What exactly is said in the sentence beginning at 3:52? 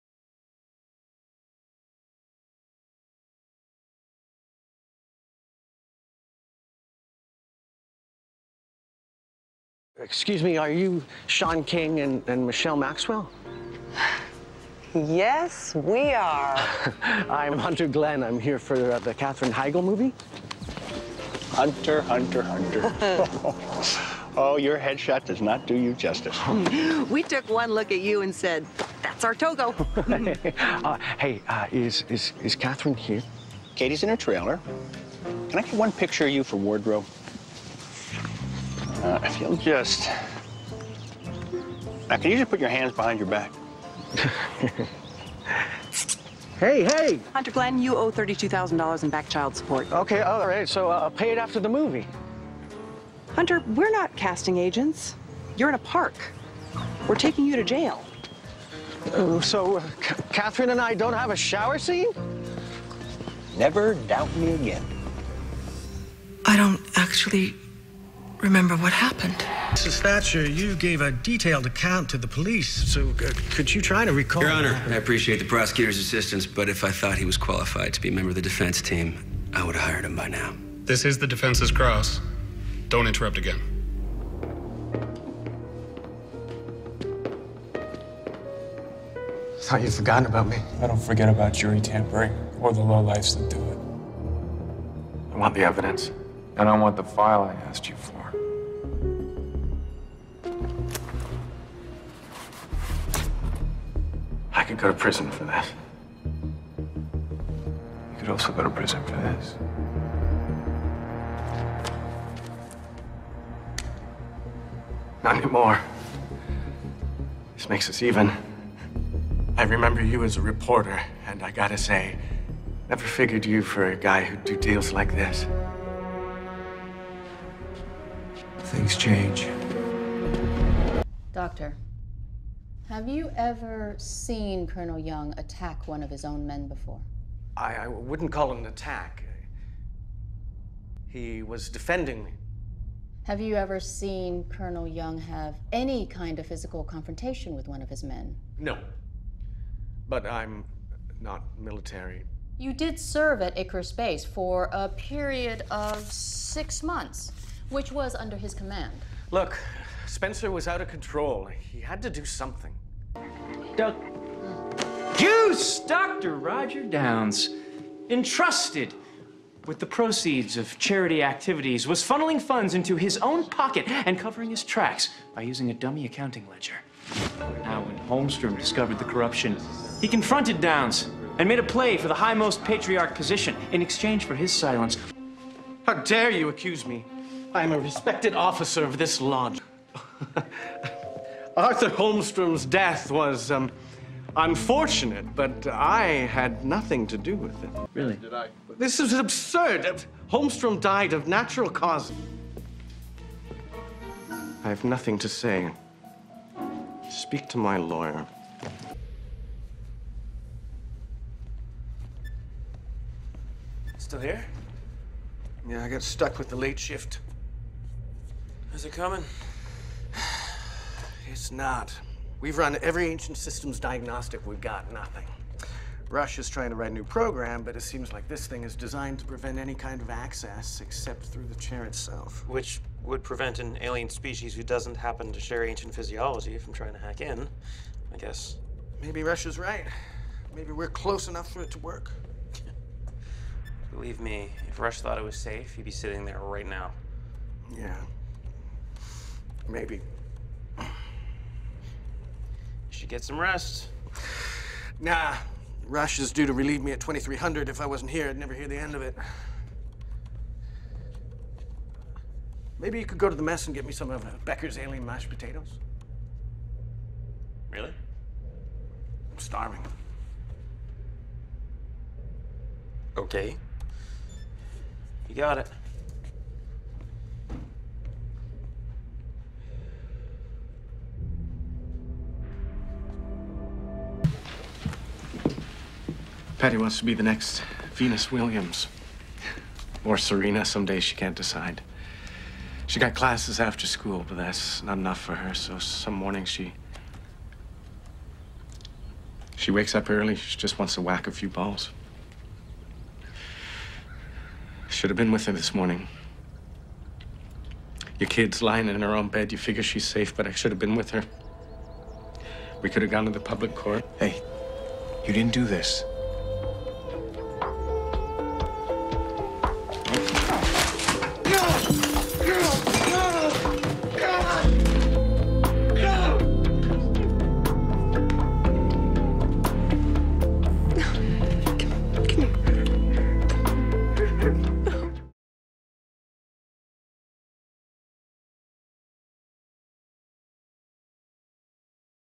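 Which would prevent an alien species who doesn't happen to share ancient physiology from trying to hack in, I guess.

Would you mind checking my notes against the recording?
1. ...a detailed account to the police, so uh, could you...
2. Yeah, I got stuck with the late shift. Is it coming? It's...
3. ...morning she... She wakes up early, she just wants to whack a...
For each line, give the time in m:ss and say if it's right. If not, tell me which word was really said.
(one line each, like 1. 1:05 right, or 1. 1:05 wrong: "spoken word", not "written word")
1. 1:11 right
2. 3:35 right
3. 4:56 right.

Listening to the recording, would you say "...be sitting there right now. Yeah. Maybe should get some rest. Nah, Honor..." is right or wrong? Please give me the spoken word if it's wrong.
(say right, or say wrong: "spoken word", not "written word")
wrong: "Rush", not "Honor".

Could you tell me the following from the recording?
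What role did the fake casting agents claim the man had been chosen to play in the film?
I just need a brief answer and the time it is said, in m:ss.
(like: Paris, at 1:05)
Togo, at 0:29.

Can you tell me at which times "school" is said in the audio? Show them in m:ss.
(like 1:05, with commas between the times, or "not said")
4:53.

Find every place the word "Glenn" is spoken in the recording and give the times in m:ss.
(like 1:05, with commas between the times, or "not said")
0:17, 0:47.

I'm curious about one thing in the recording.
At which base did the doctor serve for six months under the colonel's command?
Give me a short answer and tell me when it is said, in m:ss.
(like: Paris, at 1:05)
Icarus Base, at 2:33.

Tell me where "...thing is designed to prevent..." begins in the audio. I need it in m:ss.
3:48.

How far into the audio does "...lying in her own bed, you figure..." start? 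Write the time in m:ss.
5:08.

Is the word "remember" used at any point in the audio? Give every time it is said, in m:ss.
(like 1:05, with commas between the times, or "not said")
1:08, 1:59.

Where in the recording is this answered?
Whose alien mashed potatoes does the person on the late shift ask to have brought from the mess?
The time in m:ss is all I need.
4:24.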